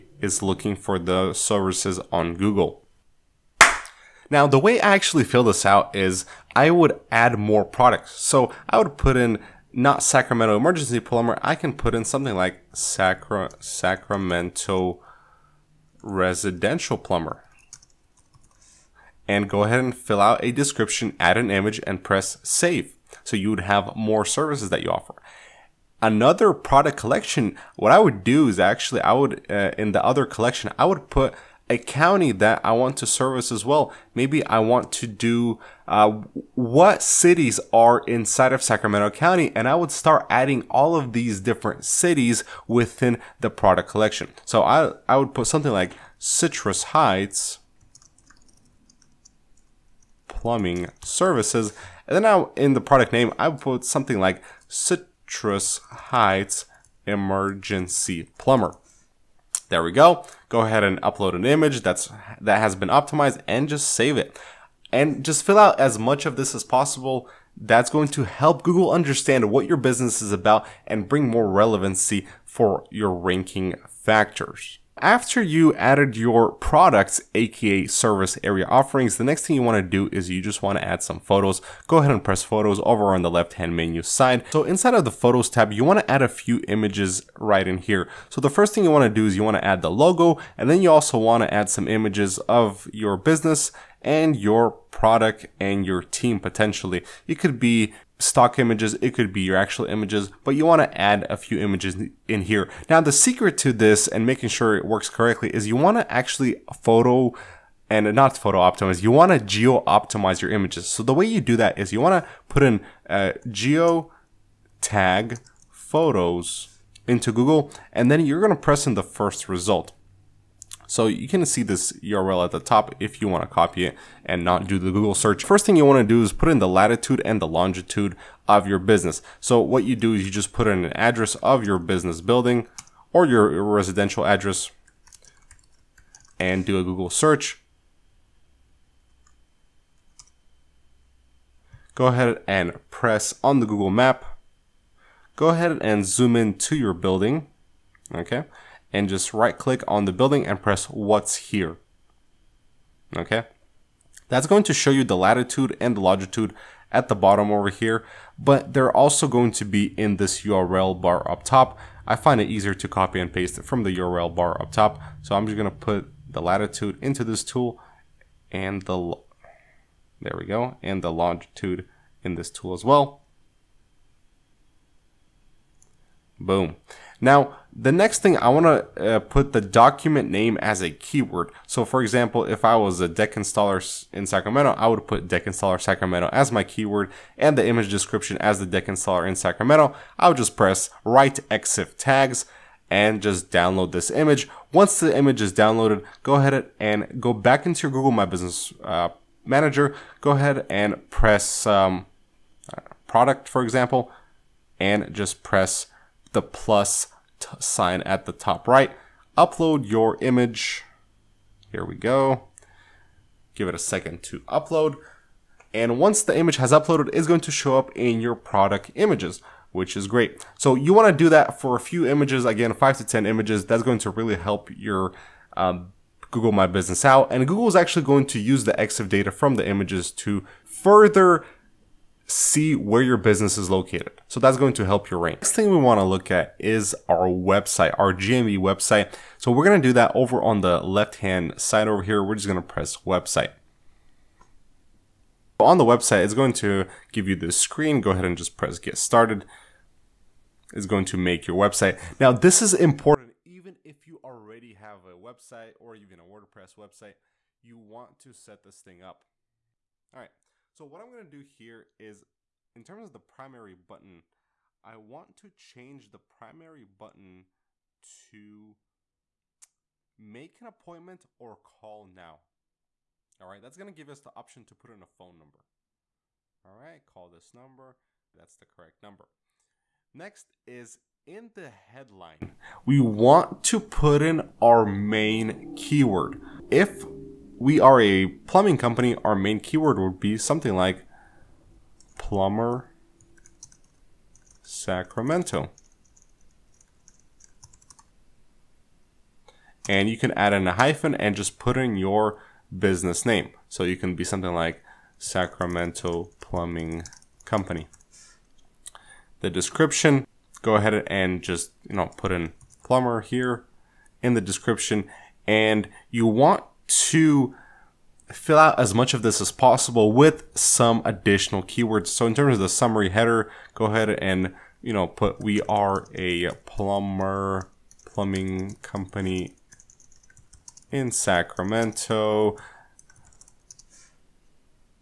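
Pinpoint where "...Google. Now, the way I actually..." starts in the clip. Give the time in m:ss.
0:02.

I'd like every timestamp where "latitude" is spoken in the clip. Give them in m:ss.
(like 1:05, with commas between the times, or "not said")
2:06, 2:35, 2:46.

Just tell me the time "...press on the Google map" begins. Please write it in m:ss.
2:22.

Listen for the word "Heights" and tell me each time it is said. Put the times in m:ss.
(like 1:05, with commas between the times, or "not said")
0:46, 0:55.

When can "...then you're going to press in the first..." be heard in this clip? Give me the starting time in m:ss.
1:58.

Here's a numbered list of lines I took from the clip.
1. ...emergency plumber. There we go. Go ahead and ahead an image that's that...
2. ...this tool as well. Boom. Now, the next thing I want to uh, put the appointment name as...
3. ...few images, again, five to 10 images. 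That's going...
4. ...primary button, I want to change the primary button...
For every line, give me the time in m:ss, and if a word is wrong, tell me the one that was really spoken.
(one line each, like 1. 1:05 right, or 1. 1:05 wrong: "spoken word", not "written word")
1. 0:57 wrong: "upload", not "ahead"
2. 2:52 wrong: "document", not "appointment"
3. 3:41 right
4. 4:23 right.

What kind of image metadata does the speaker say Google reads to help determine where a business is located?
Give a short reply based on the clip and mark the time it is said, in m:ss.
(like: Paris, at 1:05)
EXIF data, at 3:48.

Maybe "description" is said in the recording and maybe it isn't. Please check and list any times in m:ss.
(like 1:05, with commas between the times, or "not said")
0:20, 3:07, 5:09, 5:14.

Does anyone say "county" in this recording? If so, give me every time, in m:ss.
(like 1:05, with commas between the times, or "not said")
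0:31, 0:39.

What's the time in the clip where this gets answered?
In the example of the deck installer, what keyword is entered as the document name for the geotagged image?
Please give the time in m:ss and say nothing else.
3:05.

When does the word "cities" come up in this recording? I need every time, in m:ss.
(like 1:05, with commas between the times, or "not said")
0:37, 0:41.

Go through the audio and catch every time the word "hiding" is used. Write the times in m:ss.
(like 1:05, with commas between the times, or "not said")
not said.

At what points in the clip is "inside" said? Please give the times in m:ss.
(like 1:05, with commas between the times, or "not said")
0:38, 1:24.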